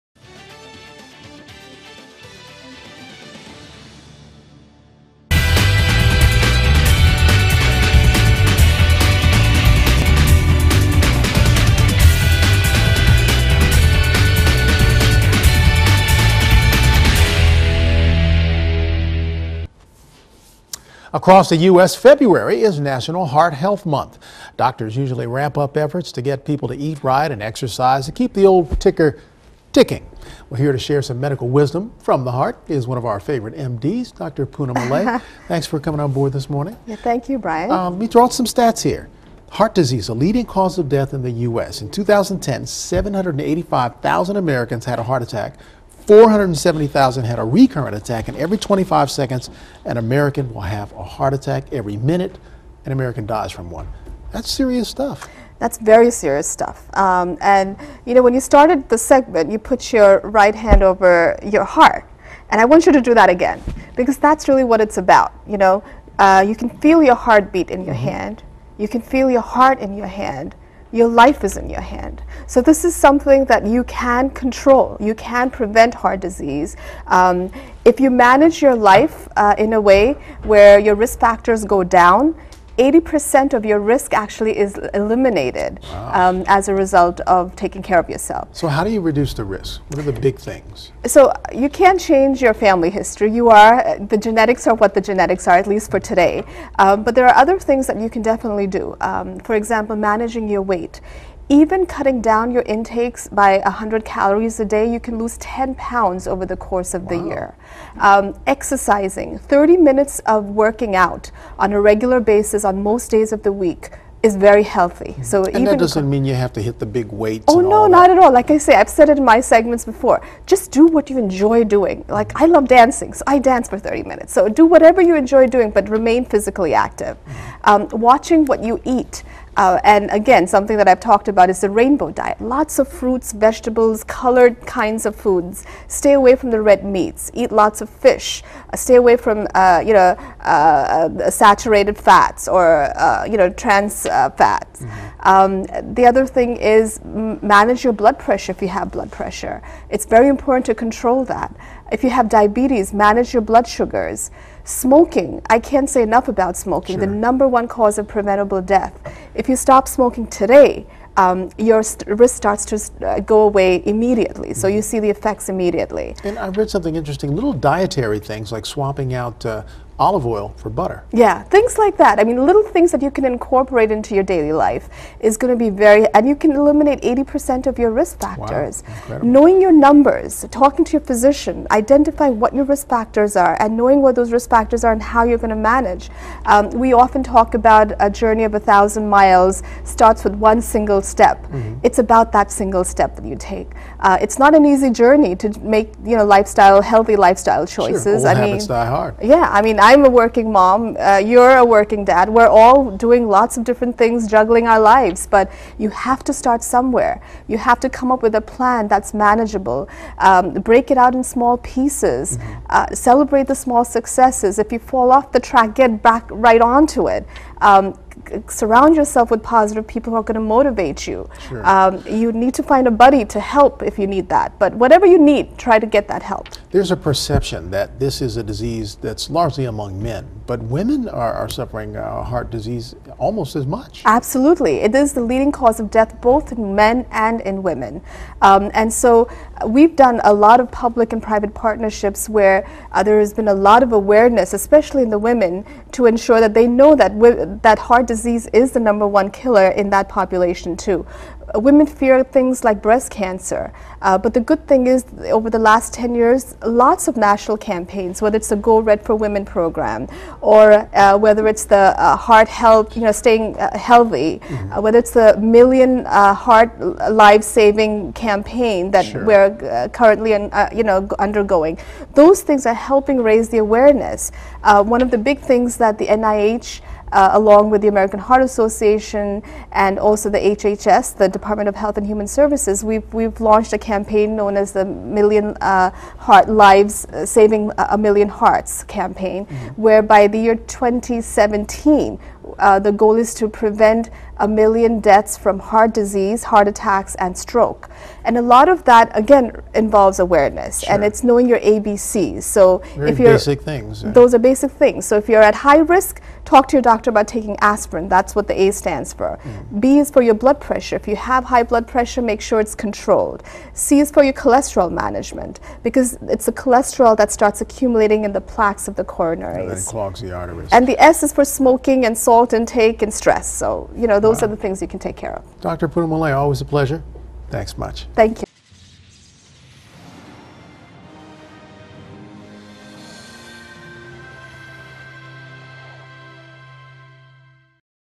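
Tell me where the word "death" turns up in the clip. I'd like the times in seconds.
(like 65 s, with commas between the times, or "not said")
40 s, 158 s, 235 s, 295 s.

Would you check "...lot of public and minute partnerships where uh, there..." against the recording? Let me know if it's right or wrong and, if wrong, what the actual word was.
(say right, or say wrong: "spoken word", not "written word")
wrong: "private", not "minute".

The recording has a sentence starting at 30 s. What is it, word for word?
We're here to share some medical wisdom from the heart is one of our favorite MDs, Dr.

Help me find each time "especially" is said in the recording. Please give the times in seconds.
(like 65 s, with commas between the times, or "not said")
244 s.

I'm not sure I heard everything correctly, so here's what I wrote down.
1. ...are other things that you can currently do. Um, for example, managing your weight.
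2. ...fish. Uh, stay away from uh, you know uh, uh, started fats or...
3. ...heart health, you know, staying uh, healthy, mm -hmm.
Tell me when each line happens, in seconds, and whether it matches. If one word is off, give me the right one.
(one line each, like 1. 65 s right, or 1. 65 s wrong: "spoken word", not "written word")
1. 97 s wrong: "definitely", not "currently"
2. 137 s wrong: "saturated", not "started"
3. 262 s right.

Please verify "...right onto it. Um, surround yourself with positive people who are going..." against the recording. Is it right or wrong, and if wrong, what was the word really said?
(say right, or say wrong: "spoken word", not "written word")
right.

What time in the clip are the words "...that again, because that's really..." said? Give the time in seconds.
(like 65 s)
63 s.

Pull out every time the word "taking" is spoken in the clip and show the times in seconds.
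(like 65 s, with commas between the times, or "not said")
87 s, 307 s.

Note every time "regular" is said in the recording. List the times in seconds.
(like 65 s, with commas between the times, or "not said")
111 s.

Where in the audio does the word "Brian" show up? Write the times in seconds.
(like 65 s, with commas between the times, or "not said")
37 s.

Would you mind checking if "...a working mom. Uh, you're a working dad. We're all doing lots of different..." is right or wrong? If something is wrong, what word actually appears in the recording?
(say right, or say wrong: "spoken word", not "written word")
right.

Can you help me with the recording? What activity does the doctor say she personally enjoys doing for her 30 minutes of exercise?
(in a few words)
Dancing.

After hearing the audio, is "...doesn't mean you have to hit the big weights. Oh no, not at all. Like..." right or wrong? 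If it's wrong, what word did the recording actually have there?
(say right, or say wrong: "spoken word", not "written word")
right.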